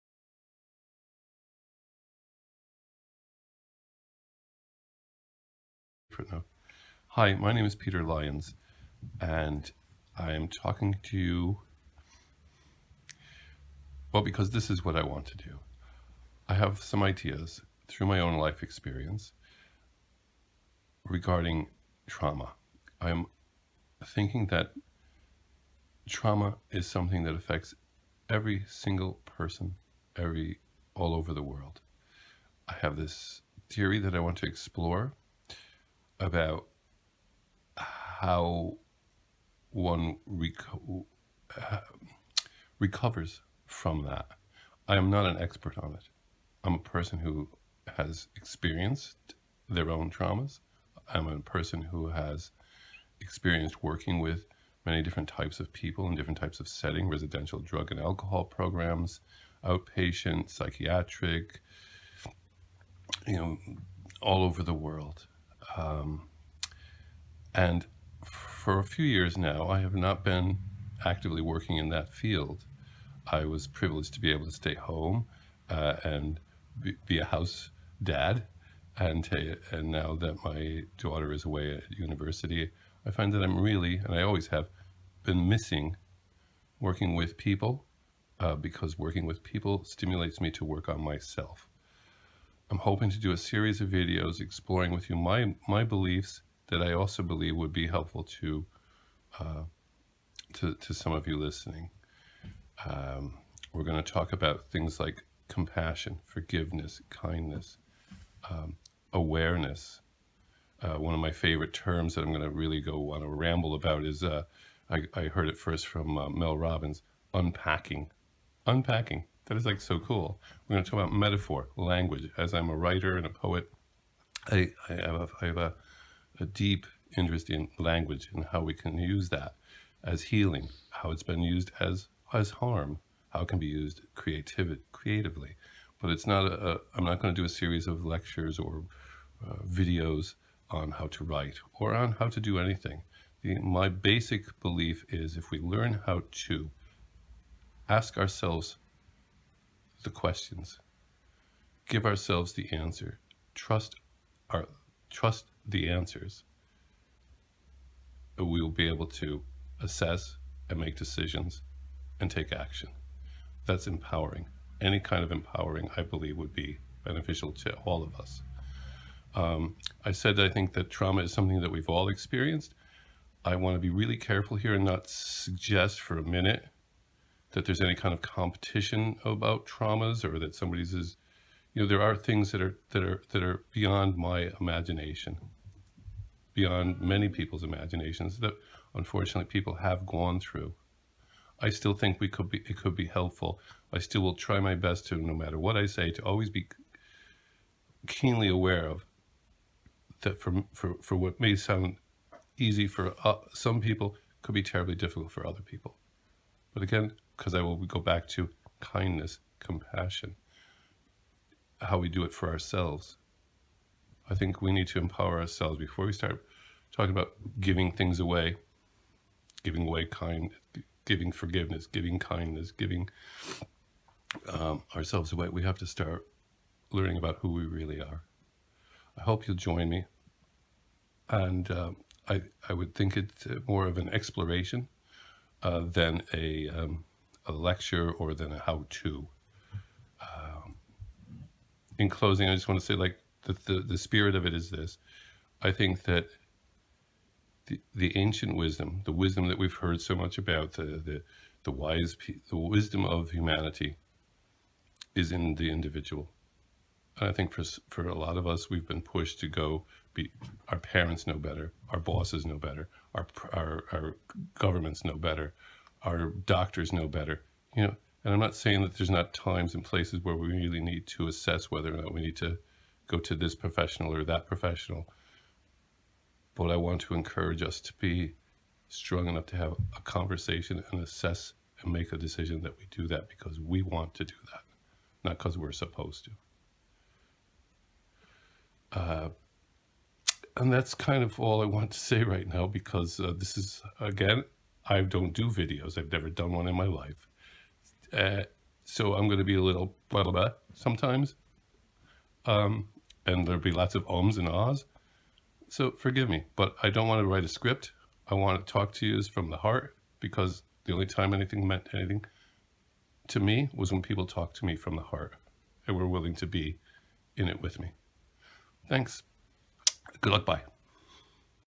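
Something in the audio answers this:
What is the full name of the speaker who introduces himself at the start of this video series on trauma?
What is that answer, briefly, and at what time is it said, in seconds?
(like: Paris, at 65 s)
Peter Lyons, at 7 s.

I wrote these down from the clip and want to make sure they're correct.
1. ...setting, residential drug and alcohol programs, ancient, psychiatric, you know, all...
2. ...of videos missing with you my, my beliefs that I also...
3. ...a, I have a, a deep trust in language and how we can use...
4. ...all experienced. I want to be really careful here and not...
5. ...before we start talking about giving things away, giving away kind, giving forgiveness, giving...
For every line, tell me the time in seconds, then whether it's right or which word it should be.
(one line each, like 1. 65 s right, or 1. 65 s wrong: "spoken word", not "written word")
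1. 56 s wrong: "outpatient", not "ancient"
2. 93 s wrong: "exploring", not "missing"
3. 125 s wrong: "interest", not "trust"
4. 171 s right
5. 215 s right.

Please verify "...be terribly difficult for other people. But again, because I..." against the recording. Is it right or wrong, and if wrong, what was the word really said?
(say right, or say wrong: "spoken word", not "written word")
right.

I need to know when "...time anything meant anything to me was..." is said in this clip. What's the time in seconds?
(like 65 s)
311 s.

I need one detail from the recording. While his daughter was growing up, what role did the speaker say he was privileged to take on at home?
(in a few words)
house dad.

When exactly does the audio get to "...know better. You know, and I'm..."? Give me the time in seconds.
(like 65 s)
266 s.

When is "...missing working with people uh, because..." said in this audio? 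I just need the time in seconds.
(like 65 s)
85 s.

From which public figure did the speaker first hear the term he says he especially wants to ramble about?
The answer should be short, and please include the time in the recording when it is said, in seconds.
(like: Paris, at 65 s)
Mel Robbins, at 116 s.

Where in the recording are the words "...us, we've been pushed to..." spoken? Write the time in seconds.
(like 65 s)
258 s.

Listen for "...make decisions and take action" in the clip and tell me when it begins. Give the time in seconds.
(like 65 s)
160 s.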